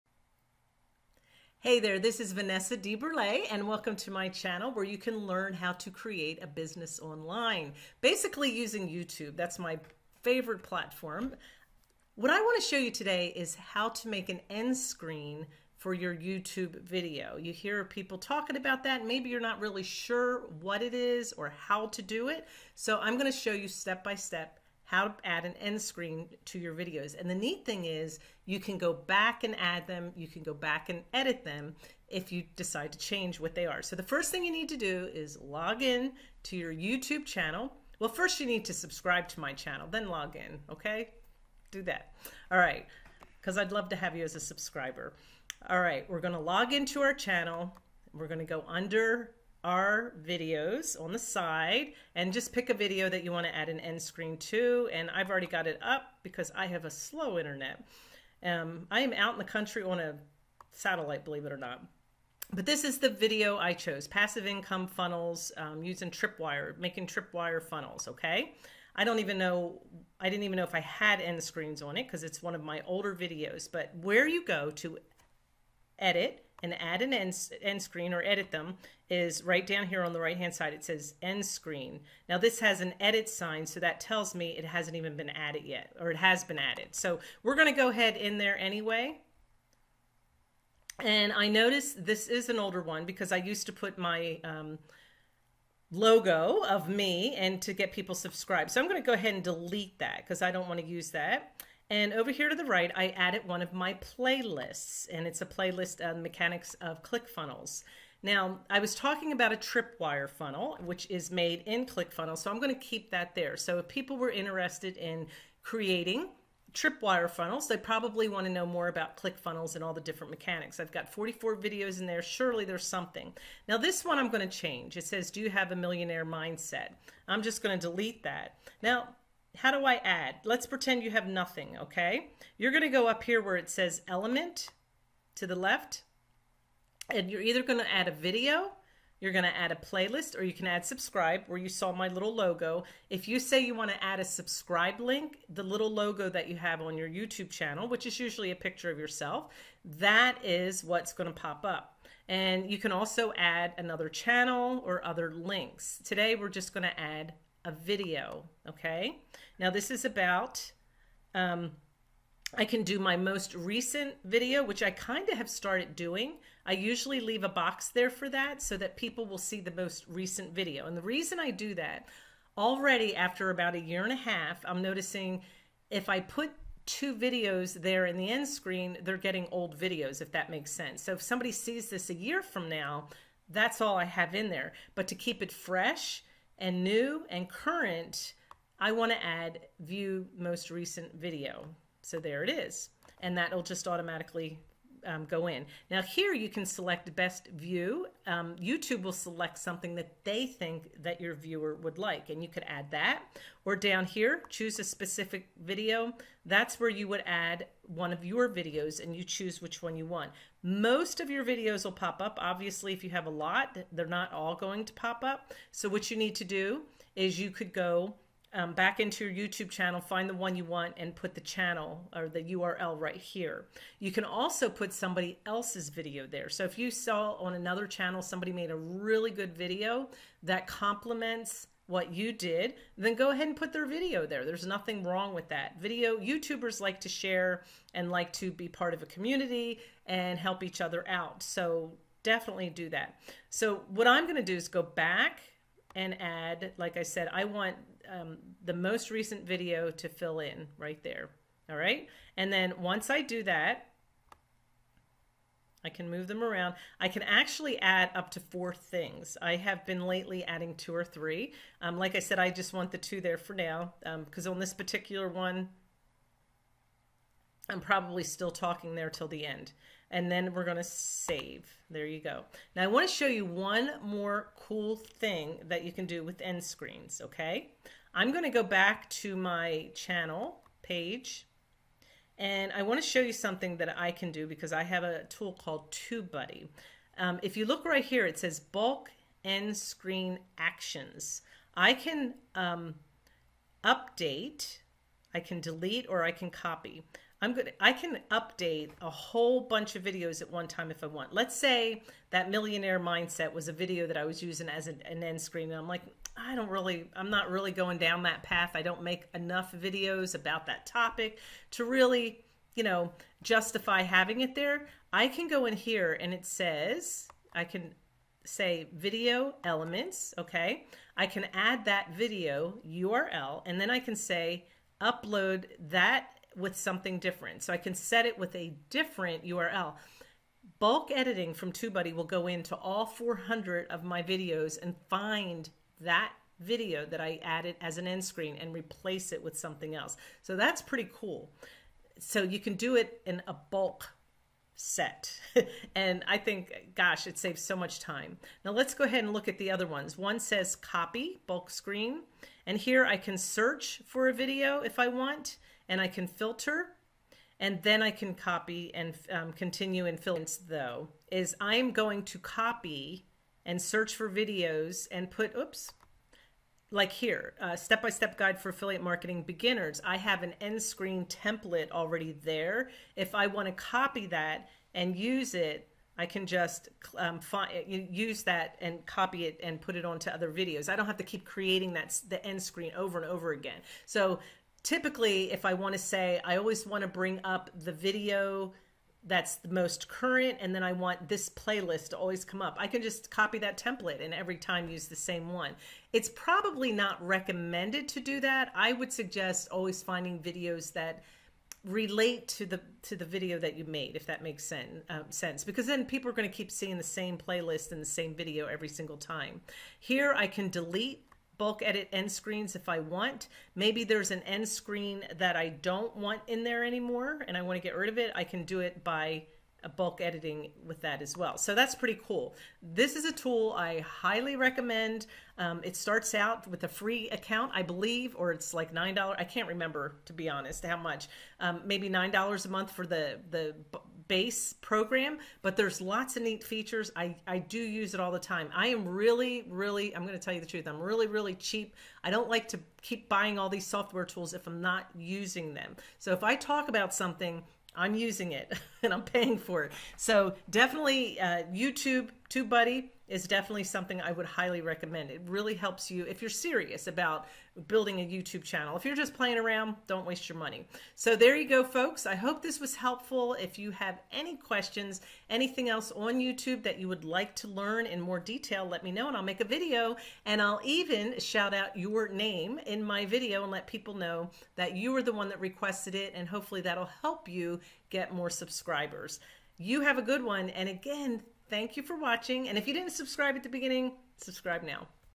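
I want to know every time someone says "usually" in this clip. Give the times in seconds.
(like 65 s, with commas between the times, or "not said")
148 s, 166 s.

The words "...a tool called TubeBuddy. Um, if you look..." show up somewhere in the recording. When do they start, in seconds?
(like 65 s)
285 s.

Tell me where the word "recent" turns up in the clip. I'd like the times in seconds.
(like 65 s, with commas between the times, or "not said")
163 s, 170 s, 190 s, 249 s.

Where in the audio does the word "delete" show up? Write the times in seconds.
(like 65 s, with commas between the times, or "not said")
99 s, 127 s, 295 s, 410 s.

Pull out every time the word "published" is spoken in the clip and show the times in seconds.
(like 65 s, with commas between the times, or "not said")
not said.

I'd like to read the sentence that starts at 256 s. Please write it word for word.
I can actually add up to four things.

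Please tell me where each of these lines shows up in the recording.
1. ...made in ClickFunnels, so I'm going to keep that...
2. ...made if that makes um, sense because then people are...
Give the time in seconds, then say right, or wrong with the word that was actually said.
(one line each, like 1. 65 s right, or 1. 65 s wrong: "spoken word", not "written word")
1. 111 s right
2. 403 s right.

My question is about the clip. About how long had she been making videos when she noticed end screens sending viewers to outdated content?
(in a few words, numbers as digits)
A year and a half.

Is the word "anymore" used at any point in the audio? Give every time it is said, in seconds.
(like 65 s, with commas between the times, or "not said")
416 s.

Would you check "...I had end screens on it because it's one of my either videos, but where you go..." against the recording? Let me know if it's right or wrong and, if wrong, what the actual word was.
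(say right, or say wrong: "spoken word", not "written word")
wrong: "older", not "either".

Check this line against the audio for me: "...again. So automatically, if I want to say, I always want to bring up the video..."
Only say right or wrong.
wrong.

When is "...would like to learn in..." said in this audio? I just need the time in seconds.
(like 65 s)
467 s.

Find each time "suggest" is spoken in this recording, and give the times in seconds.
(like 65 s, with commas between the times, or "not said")
399 s.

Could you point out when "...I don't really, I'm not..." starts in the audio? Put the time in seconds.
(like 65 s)
306 s.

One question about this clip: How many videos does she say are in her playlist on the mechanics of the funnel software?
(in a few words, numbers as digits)
44.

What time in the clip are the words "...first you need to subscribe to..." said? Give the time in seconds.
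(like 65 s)
38 s.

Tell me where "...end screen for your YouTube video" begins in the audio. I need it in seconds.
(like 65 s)
14 s.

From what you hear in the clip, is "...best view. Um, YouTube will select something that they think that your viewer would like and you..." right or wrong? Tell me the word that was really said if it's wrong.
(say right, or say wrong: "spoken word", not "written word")
right.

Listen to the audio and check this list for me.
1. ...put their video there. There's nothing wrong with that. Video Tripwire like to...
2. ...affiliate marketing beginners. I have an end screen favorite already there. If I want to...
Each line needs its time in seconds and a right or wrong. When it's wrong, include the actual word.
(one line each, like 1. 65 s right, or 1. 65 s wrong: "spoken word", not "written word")
1. 233 s wrong: "YouTubers", not "Tripwire"
2. 368 s wrong: "template", not "favorite".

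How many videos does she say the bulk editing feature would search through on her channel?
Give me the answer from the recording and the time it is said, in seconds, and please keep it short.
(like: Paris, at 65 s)
400, at 333 s.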